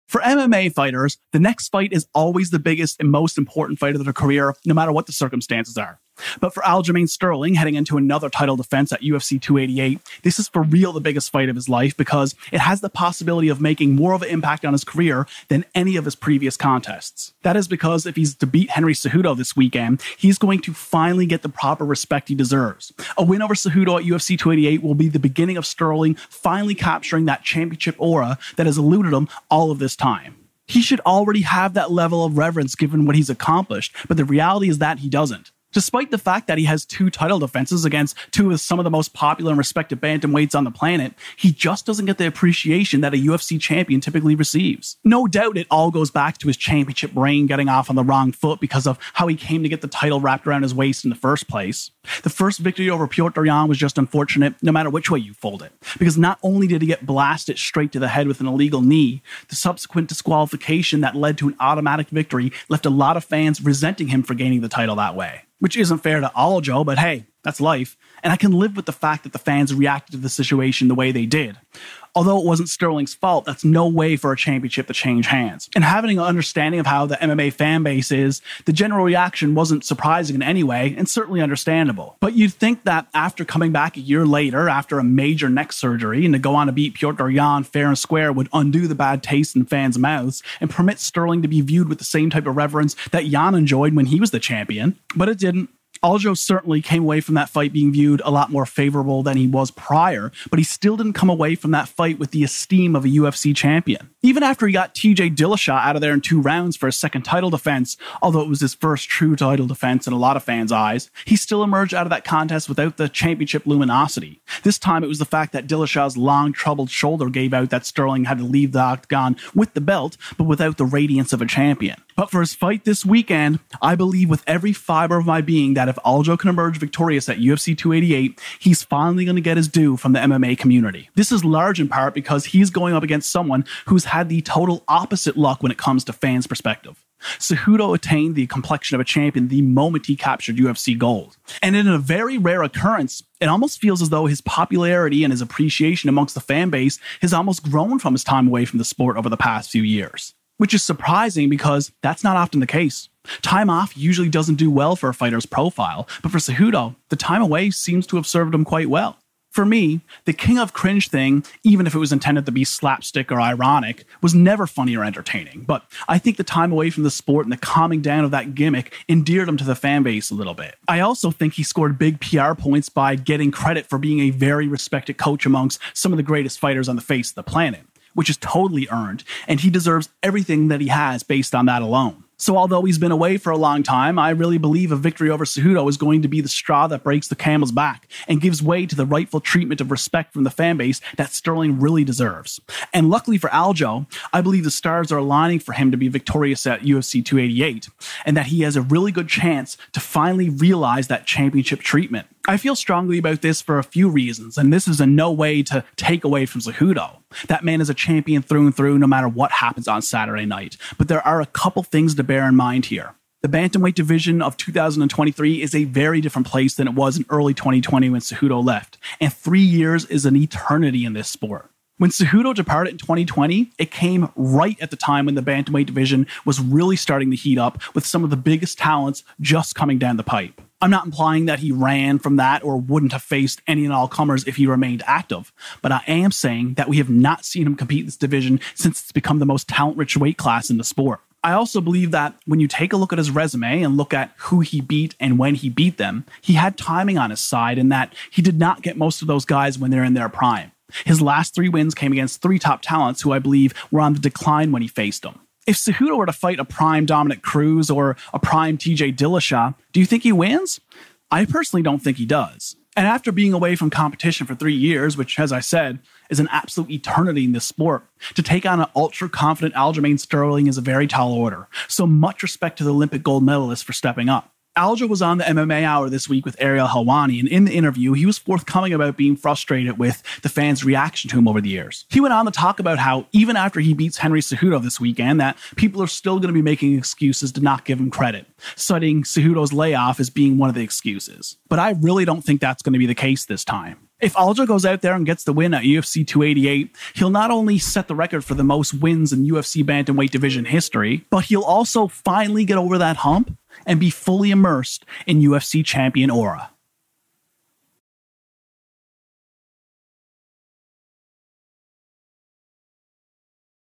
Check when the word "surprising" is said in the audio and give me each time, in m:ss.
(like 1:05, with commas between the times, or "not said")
1:19, 2:30.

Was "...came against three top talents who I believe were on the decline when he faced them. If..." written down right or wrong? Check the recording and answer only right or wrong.
right.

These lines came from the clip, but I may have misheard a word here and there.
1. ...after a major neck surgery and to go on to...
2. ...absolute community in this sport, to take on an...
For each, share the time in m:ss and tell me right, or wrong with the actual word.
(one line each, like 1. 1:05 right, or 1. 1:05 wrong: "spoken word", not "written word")
1. 1:24 right
2. 4:26 wrong: "eternity", not "community".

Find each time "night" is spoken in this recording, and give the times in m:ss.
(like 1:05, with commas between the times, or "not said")
3:30.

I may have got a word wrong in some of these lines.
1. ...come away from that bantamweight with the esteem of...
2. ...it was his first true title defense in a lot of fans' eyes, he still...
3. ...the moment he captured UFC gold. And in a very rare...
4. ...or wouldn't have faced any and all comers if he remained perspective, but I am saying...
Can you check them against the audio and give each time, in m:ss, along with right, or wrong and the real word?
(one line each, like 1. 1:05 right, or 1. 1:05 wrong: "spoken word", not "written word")
1. 1:41 wrong: "fight", not "bantamweight"
2. 1:48 right
3. 2:19 right
4. 3:52 wrong: "active", not "perspective".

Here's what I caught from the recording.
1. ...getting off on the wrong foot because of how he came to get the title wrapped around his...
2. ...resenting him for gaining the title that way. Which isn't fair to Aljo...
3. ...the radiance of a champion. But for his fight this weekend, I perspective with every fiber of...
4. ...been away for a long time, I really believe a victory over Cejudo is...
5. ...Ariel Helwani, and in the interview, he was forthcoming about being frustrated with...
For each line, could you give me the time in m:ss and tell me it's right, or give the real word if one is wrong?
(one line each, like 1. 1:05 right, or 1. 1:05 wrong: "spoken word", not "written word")
1. 0:47 right
2. 1:03 right
3. 2:00 wrong: "believe", not "perspective"
4. 3:02 right
5. 4:36 right.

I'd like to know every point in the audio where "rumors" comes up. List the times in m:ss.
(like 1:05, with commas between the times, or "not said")
not said.